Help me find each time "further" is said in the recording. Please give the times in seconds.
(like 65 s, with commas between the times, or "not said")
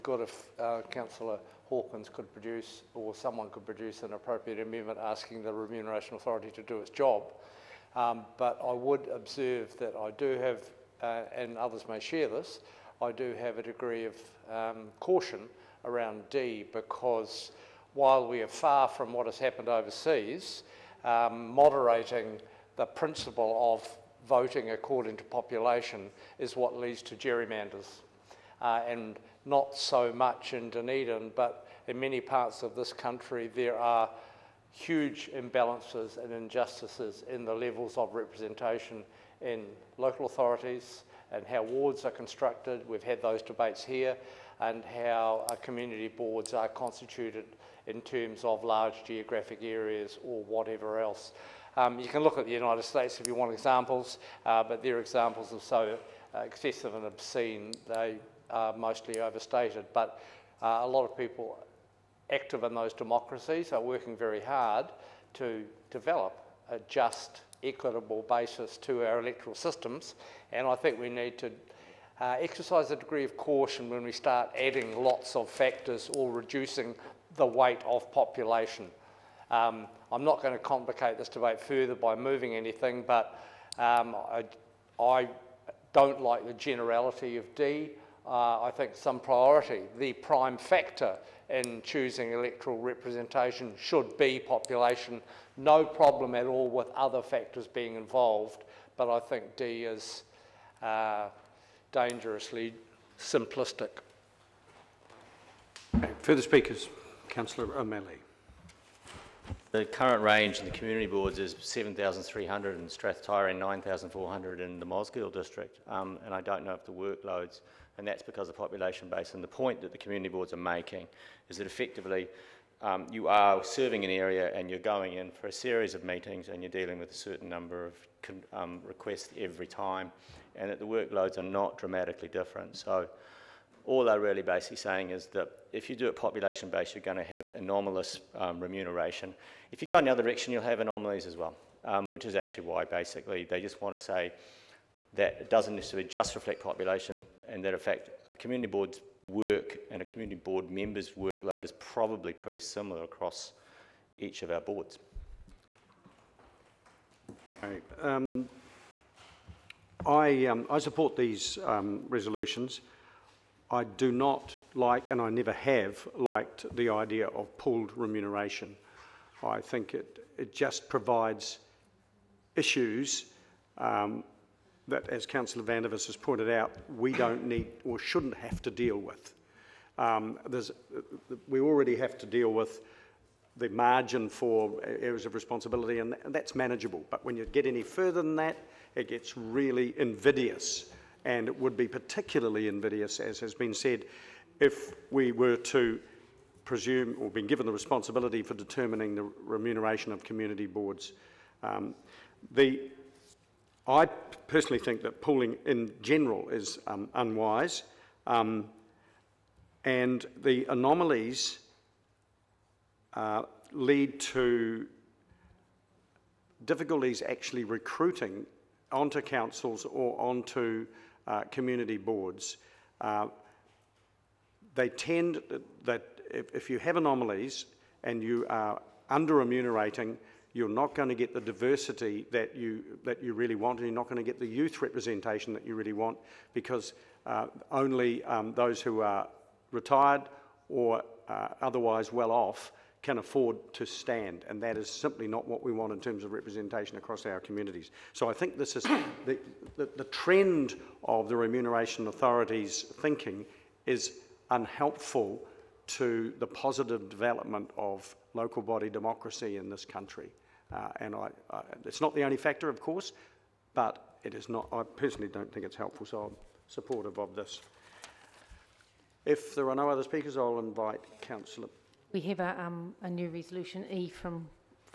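81 s, 106 s, 187 s.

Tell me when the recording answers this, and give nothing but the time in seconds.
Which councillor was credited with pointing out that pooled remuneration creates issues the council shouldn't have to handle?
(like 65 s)
175 s.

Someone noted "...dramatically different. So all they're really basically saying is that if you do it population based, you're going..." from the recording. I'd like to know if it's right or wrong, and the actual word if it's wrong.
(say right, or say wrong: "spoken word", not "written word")
right.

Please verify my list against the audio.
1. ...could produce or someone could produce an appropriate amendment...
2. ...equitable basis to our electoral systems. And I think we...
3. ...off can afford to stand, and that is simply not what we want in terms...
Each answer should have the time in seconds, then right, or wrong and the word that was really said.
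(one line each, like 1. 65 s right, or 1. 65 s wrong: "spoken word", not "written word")
1. 2 s right
2. 67 s right
3. 242 s right.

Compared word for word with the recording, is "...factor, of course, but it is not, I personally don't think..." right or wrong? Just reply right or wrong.
right.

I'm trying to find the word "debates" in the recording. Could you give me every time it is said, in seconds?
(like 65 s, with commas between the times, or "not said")
43 s, 81 s.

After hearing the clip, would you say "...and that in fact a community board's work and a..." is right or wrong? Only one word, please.
right.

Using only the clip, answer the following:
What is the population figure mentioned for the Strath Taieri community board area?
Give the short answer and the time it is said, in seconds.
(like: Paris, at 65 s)
7,300, at 111 s.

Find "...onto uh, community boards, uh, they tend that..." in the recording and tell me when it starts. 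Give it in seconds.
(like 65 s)
220 s.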